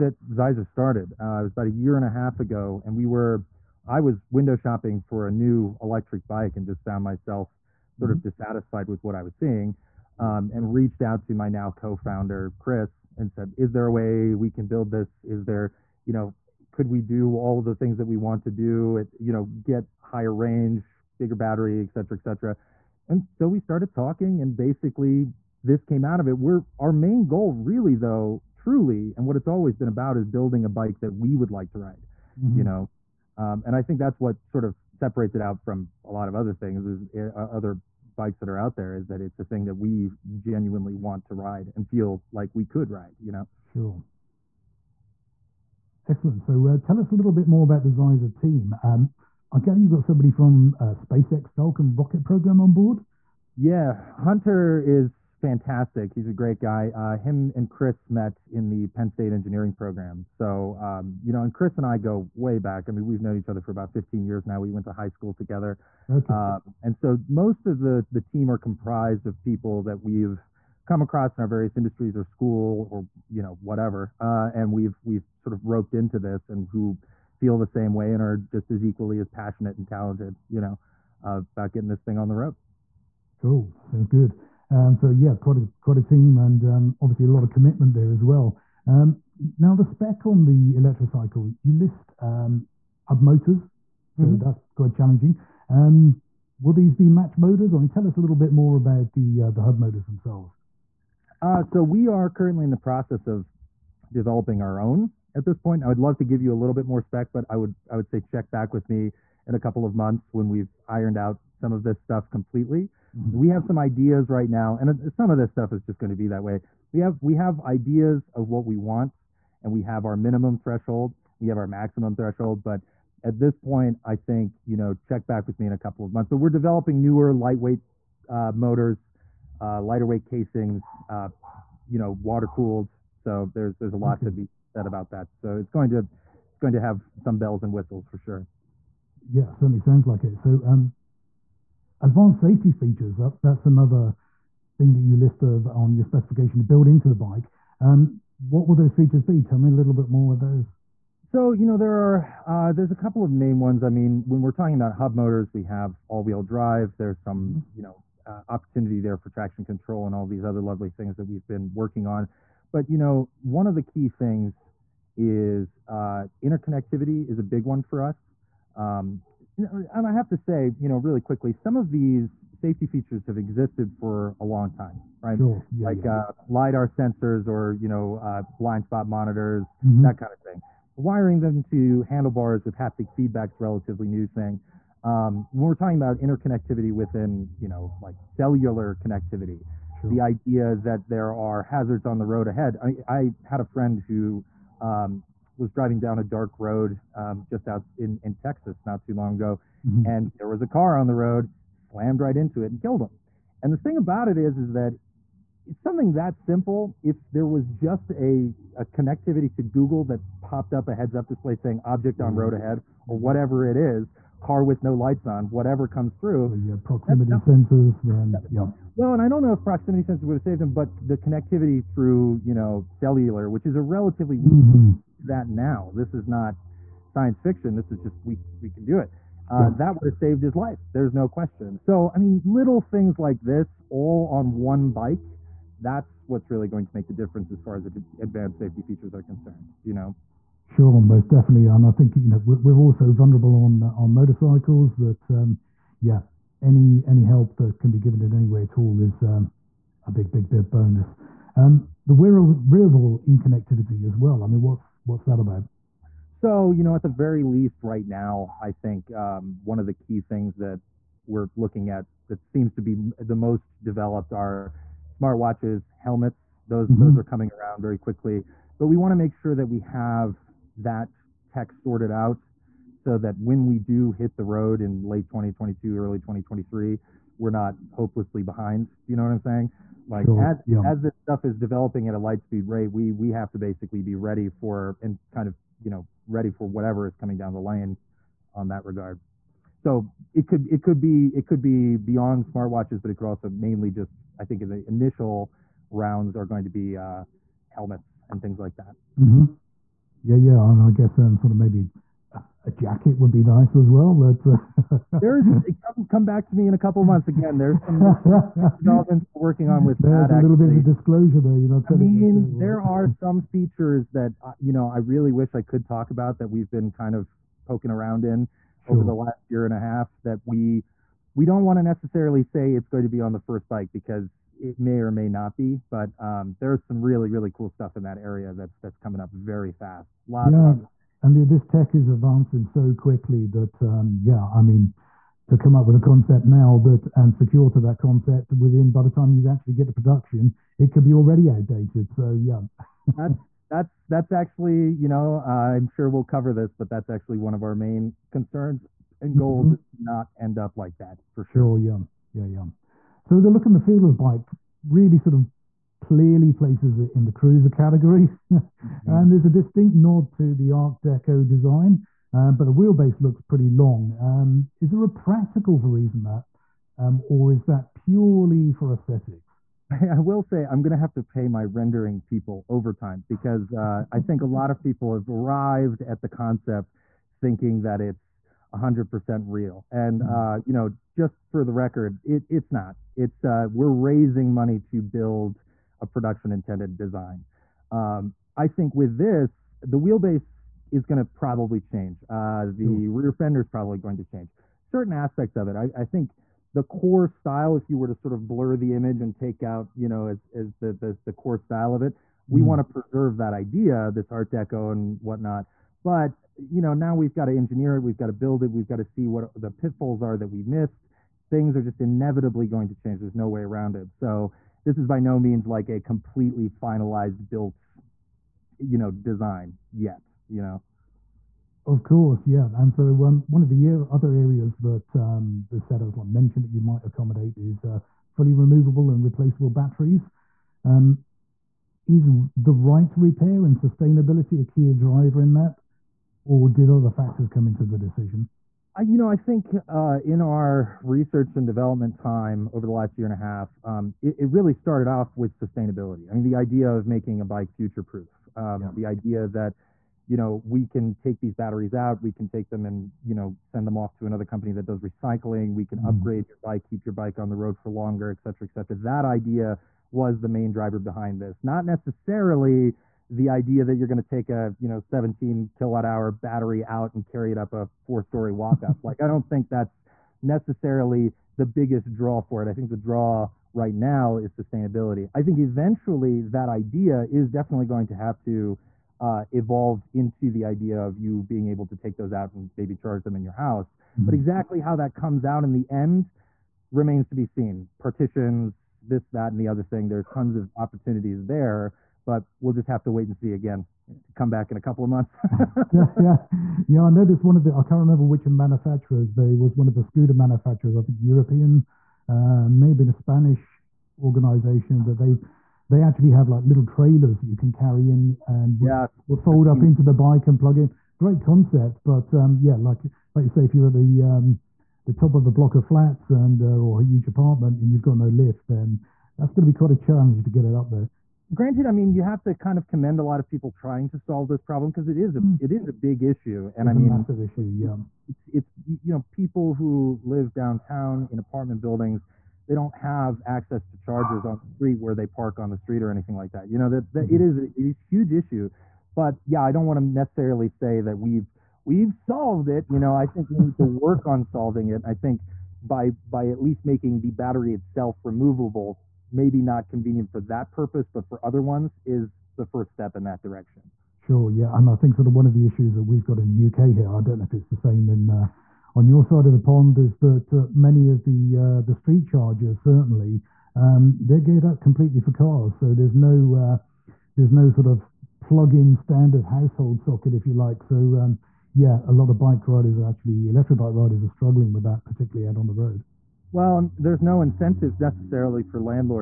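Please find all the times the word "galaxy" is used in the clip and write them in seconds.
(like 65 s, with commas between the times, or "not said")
not said.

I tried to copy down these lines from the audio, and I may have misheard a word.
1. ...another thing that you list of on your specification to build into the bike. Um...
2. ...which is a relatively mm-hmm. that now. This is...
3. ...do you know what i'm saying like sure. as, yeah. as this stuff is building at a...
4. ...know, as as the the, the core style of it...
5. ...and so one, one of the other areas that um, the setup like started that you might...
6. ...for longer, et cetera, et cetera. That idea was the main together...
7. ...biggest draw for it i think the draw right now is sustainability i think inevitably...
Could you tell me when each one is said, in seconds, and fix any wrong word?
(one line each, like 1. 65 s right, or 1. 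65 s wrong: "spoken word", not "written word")
1. 143 s right
2. 223 s right
3. 278 s wrong: "developing", not "building"
4. 400 s right
5. 422 s wrong: "mentioned", not "started"
6. 457 s wrong: "driver", not "together"
7. 471 s wrong: "eventually", not "inevitably".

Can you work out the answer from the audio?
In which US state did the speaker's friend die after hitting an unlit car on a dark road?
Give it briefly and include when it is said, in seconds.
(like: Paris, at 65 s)
Texas, at 198 s.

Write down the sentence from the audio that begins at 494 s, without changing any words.
Come back in a couple of months.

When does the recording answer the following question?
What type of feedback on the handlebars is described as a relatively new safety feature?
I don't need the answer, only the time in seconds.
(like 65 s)
182 s.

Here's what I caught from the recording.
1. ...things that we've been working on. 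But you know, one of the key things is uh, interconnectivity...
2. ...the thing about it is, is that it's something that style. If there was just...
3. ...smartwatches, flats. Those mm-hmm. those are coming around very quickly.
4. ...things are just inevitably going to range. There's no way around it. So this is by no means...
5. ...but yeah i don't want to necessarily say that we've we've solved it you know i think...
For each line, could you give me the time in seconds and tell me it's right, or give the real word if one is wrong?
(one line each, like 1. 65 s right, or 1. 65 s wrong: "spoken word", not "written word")
1. 160 s right
2. 203 s wrong: "simple", not "style"
3. 265 s wrong: "helmets", not "flats"
4. 411 s wrong: "change", not "range"
5. 539 s right.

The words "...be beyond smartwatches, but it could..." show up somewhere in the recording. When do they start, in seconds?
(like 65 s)
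291 s.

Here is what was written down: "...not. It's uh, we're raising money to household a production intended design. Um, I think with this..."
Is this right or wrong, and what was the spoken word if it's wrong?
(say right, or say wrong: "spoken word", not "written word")
wrong: "build", not "household".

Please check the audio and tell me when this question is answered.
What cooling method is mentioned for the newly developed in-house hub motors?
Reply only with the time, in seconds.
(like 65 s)
132 s.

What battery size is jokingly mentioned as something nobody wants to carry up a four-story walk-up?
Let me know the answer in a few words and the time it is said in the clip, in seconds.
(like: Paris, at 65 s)
17 kilowatt hour, at 464 s.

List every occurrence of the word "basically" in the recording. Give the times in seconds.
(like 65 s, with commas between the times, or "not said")
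24 s, 283 s.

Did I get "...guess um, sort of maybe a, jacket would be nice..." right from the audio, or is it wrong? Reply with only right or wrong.
right.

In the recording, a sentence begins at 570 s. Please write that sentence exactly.
So um, yeah, a lot of bike riders are actually electric bike riders are struggling with that, particularly out on the road.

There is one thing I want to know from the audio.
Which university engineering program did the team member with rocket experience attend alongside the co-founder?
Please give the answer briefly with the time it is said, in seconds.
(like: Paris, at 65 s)
Penn State, at 58 s.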